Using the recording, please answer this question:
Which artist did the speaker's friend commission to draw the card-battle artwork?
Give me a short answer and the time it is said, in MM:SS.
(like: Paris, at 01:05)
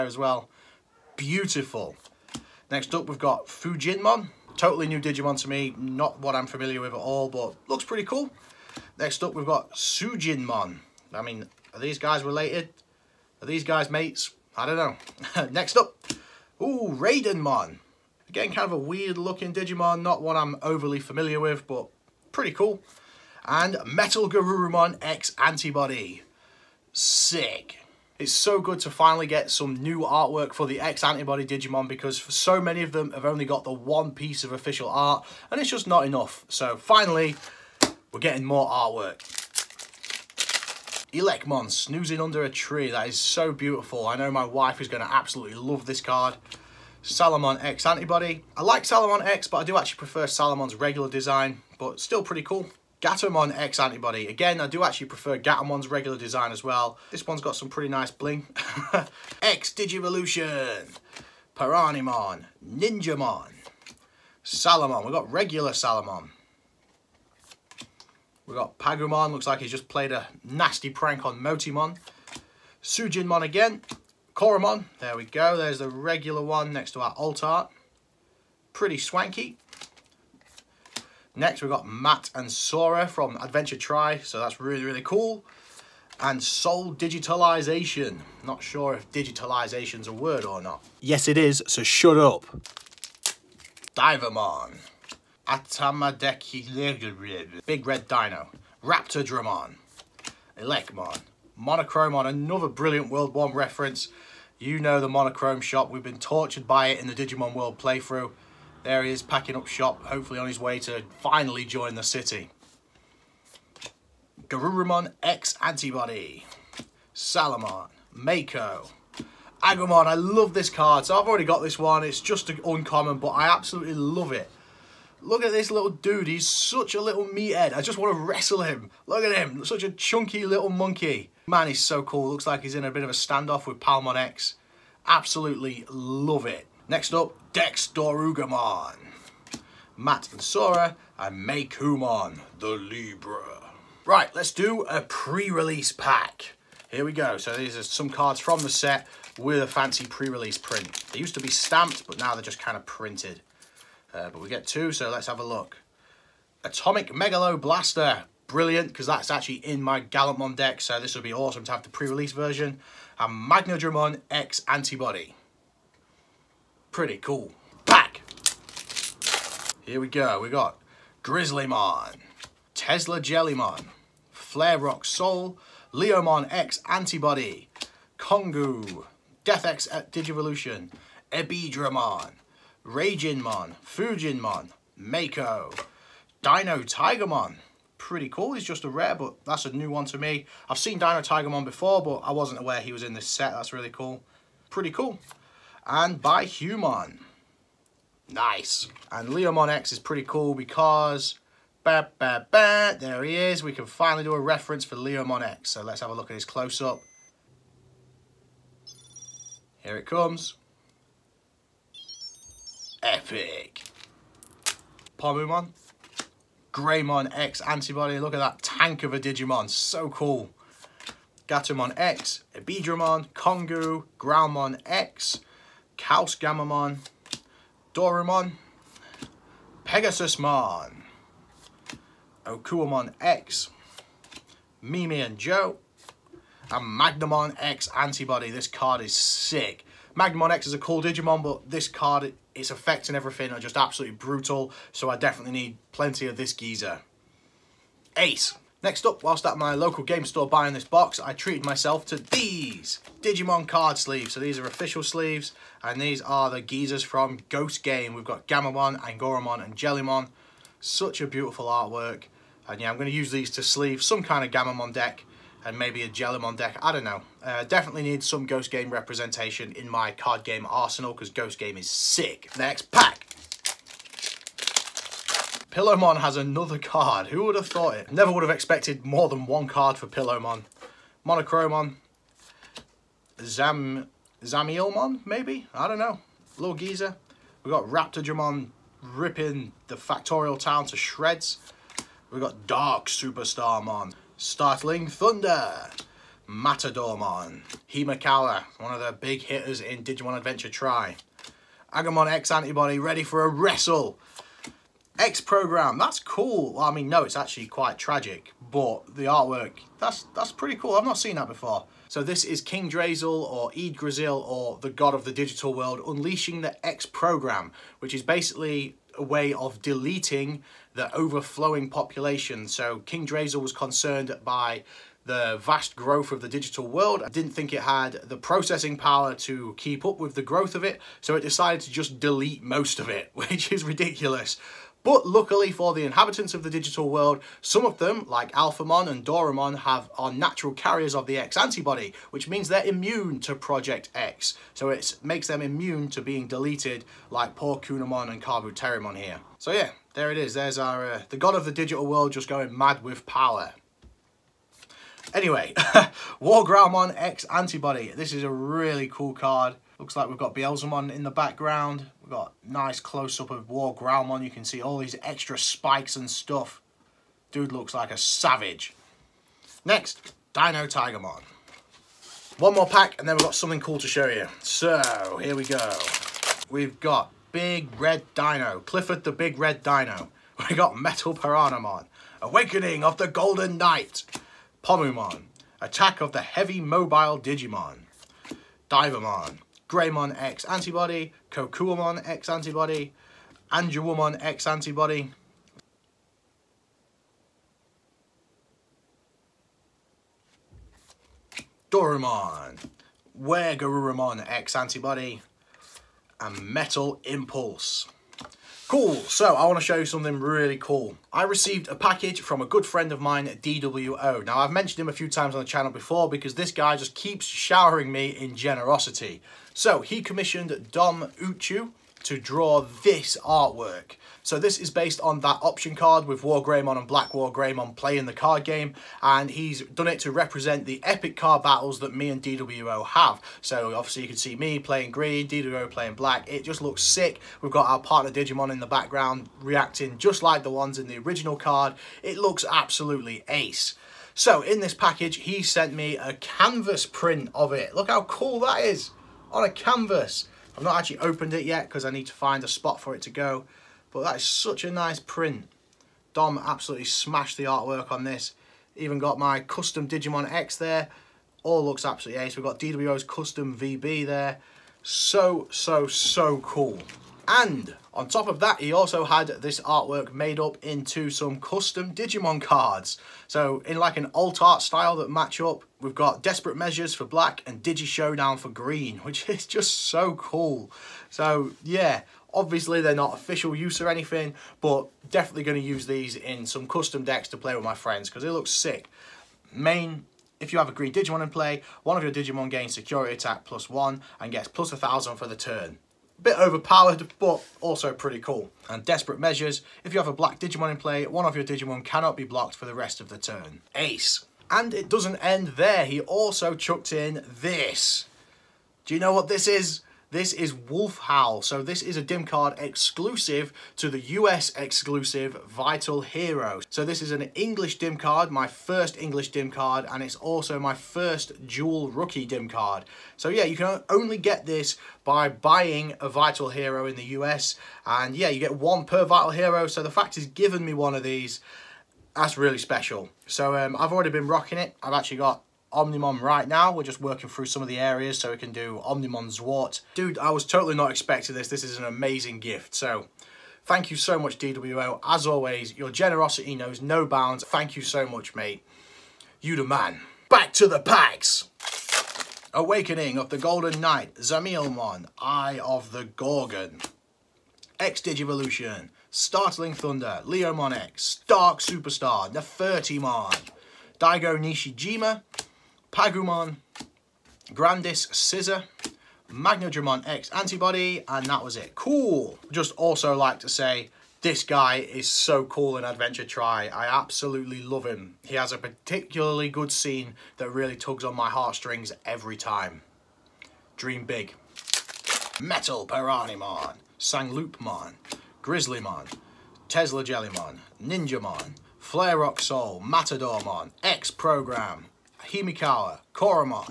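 Dom Uchu, at 07:00.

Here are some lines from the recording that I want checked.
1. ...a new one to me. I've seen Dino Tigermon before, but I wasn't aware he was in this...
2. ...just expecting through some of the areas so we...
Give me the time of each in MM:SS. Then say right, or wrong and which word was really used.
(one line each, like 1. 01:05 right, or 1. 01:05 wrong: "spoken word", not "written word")
1. 03:09 right
2. 08:57 wrong: "working", not "expecting".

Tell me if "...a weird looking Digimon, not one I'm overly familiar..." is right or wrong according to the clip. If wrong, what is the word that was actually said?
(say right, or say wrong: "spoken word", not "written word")
right.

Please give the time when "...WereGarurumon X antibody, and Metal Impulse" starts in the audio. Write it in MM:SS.
06:43.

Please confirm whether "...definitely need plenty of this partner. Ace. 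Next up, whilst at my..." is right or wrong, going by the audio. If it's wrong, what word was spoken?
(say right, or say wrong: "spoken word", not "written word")
wrong: "geezer", not "partner".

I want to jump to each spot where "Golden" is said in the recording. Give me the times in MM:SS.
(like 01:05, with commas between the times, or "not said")
06:23, 09:13.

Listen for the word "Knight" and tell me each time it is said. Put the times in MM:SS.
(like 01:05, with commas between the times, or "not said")
06:23, 09:13.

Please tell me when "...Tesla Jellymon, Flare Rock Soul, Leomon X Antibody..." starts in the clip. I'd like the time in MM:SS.
02:52.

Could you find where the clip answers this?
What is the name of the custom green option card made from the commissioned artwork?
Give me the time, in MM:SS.
07:57.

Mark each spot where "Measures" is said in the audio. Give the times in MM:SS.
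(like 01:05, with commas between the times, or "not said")
07:56, 08:19.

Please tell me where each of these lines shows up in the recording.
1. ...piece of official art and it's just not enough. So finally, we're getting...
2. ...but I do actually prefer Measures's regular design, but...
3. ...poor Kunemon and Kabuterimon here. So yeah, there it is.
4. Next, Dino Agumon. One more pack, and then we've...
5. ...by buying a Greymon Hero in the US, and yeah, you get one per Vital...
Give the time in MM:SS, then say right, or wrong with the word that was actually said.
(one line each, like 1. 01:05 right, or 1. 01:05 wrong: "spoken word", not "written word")
1. 00:34 right
2. 00:49 wrong: "Salamon", not "Measures"
3. 05:47 right
4. 06:09 wrong: "Tigermon", not "Agumon"
5. 08:45 wrong: "Vital", not "Greymon".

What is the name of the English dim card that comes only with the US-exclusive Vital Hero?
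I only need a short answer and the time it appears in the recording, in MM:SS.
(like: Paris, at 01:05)
Wolf Howl, at 08:30.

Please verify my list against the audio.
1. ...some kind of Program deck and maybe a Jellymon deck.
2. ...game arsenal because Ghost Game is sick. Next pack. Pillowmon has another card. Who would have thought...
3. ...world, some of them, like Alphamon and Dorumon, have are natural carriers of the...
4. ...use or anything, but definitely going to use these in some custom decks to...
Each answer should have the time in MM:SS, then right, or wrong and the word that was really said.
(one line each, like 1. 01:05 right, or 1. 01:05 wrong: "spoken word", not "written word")
1. 04:24 wrong: "Gammamon", not "Program"
2. 04:30 right
3. 05:37 right
4. 08:03 right.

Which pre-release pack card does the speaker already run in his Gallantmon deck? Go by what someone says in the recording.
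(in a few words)
Atomic Megalo Blaster.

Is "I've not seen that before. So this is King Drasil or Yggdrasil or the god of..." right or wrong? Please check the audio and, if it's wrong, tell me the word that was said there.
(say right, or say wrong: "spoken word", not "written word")
right.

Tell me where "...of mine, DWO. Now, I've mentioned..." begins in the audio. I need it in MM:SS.
06:53.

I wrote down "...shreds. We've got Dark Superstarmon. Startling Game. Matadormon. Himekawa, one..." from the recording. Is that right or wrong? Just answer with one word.
wrong.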